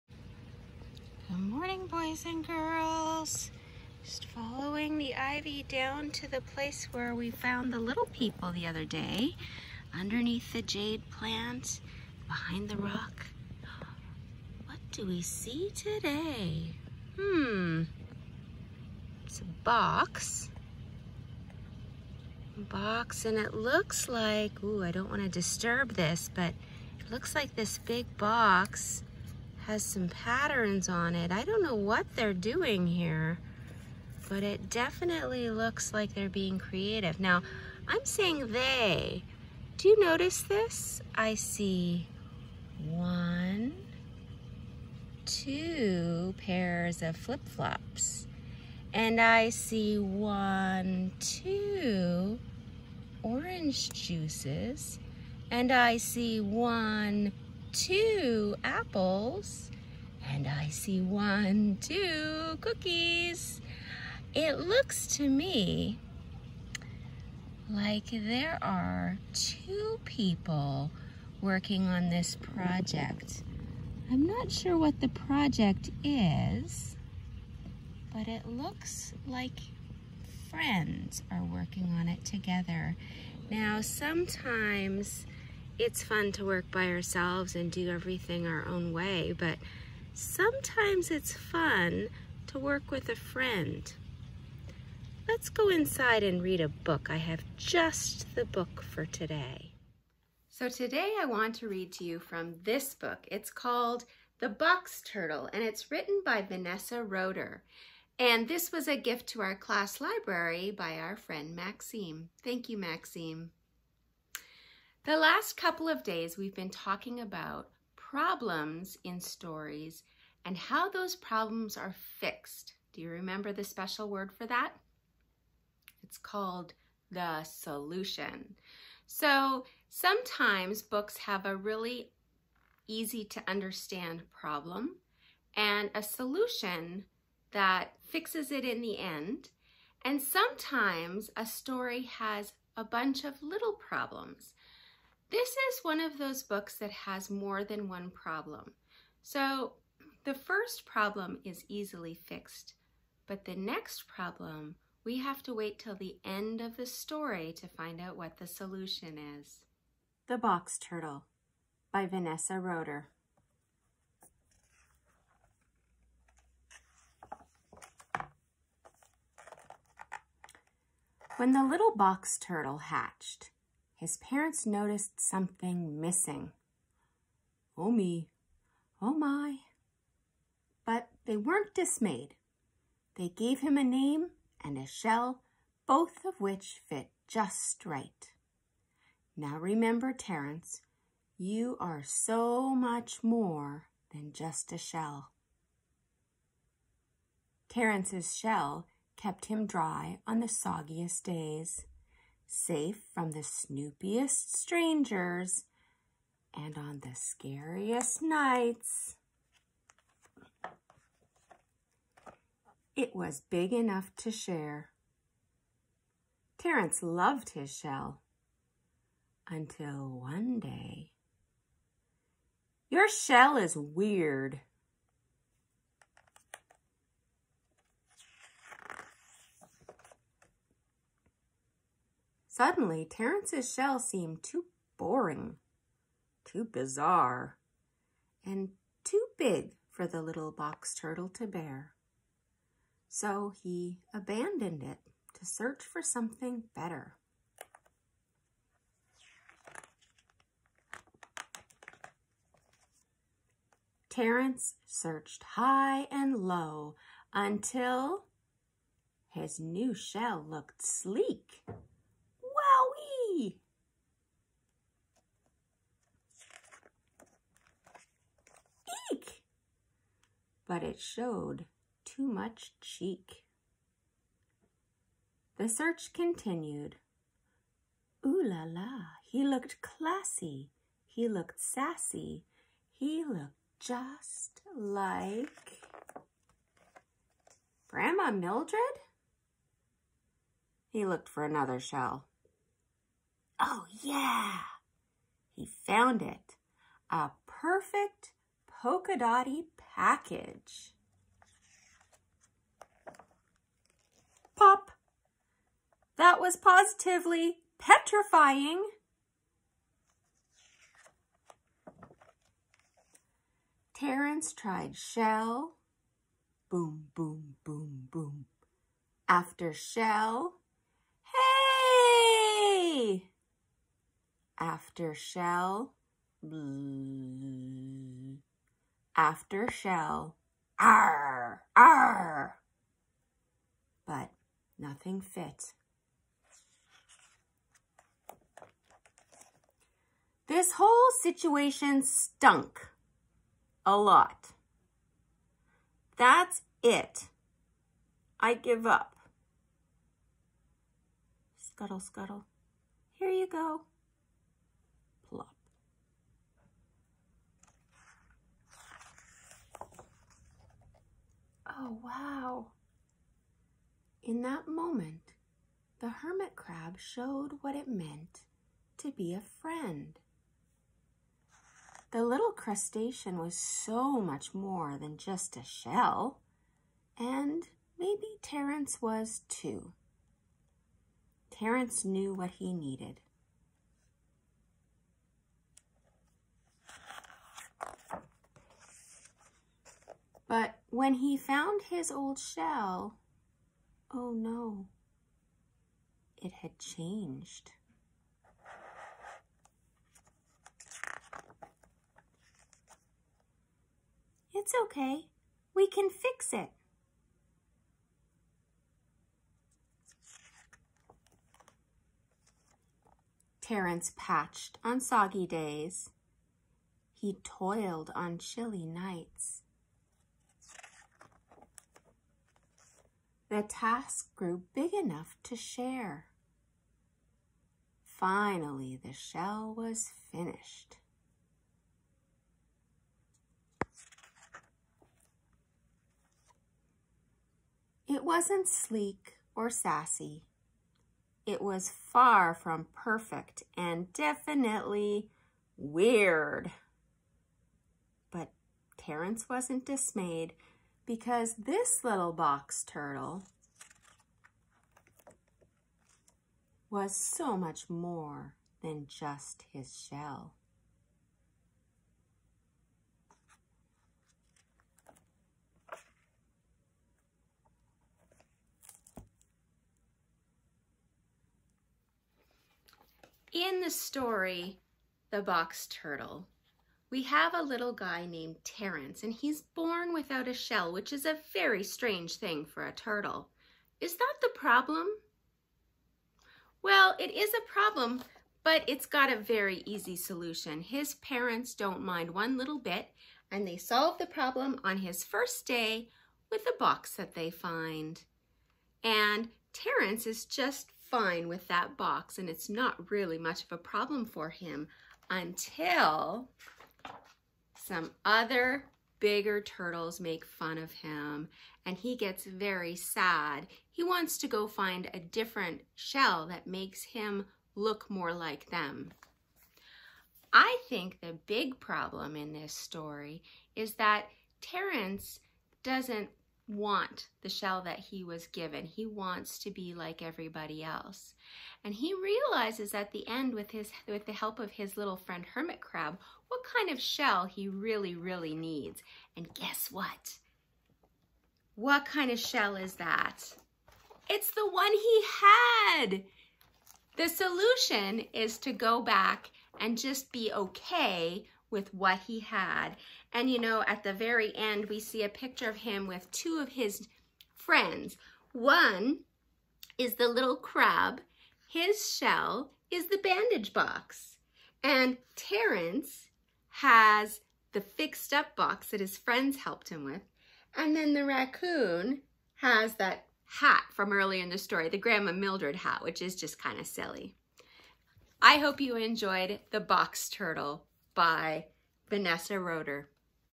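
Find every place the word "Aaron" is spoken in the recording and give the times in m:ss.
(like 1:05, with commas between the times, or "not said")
not said.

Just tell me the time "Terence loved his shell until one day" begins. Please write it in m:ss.
3:36.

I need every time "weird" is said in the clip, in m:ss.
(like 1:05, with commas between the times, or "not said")
3:43, 7:25.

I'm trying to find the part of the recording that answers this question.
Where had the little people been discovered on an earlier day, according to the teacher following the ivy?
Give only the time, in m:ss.
0:09.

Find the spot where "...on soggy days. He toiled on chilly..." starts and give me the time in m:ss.
6:54.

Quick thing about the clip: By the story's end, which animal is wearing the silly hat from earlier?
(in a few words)
Raccoon.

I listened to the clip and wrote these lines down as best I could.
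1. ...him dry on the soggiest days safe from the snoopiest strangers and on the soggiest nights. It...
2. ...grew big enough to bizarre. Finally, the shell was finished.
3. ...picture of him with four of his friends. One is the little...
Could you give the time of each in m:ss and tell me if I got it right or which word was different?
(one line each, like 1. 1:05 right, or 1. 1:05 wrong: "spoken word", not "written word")
1. 3:19 wrong: "scariest", not "soggiest"
2. 7:04 wrong: "share", not "bizarre"
3. 9:15 wrong: "two", not "four".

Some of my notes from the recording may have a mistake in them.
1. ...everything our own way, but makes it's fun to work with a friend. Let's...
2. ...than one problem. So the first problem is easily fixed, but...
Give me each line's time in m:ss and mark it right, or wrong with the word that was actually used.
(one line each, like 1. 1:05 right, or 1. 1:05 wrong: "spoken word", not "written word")
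1. 1:27 wrong: "sometimes", not "makes"
2. 2:27 right.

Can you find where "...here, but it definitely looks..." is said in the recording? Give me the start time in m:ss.
0:32.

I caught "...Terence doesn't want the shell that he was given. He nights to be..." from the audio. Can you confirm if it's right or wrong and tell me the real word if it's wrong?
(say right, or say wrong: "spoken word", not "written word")
wrong: "wants", not "nights".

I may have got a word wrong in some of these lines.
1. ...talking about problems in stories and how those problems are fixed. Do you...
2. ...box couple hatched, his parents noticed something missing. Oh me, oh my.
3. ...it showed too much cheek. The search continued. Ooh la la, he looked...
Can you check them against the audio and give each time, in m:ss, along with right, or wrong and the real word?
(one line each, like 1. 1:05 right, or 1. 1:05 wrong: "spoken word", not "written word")
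1. 1:56 right
2. 2:51 wrong: "turtle", not "couple"
3. 4:30 right.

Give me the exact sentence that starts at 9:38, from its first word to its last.
I hope you enjoyed the box turtle by Vanessa Roeder.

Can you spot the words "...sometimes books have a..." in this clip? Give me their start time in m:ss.
2:09.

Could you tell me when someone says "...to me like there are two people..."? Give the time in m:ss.
1:05.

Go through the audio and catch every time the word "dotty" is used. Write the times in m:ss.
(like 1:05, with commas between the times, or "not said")
4:59.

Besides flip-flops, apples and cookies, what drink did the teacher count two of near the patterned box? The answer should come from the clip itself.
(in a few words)
Orange juices.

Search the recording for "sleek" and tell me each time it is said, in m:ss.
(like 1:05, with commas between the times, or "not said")
4:20, 7:18.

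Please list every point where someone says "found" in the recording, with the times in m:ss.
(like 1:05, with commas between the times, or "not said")
0:07, 4:55, 6:31.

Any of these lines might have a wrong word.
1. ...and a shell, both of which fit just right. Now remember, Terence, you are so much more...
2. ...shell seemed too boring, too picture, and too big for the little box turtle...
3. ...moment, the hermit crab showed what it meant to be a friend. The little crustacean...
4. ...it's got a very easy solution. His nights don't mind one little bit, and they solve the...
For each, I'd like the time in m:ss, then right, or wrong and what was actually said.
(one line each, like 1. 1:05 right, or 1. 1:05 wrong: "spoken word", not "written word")
1. 3:04 right
2. 3:53 wrong: "bizarre", not "picture"
3. 6:04 right
4. 8:08 wrong: "parents", not "nights".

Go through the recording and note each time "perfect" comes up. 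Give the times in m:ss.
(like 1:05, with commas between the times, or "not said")
4:57, 7:22.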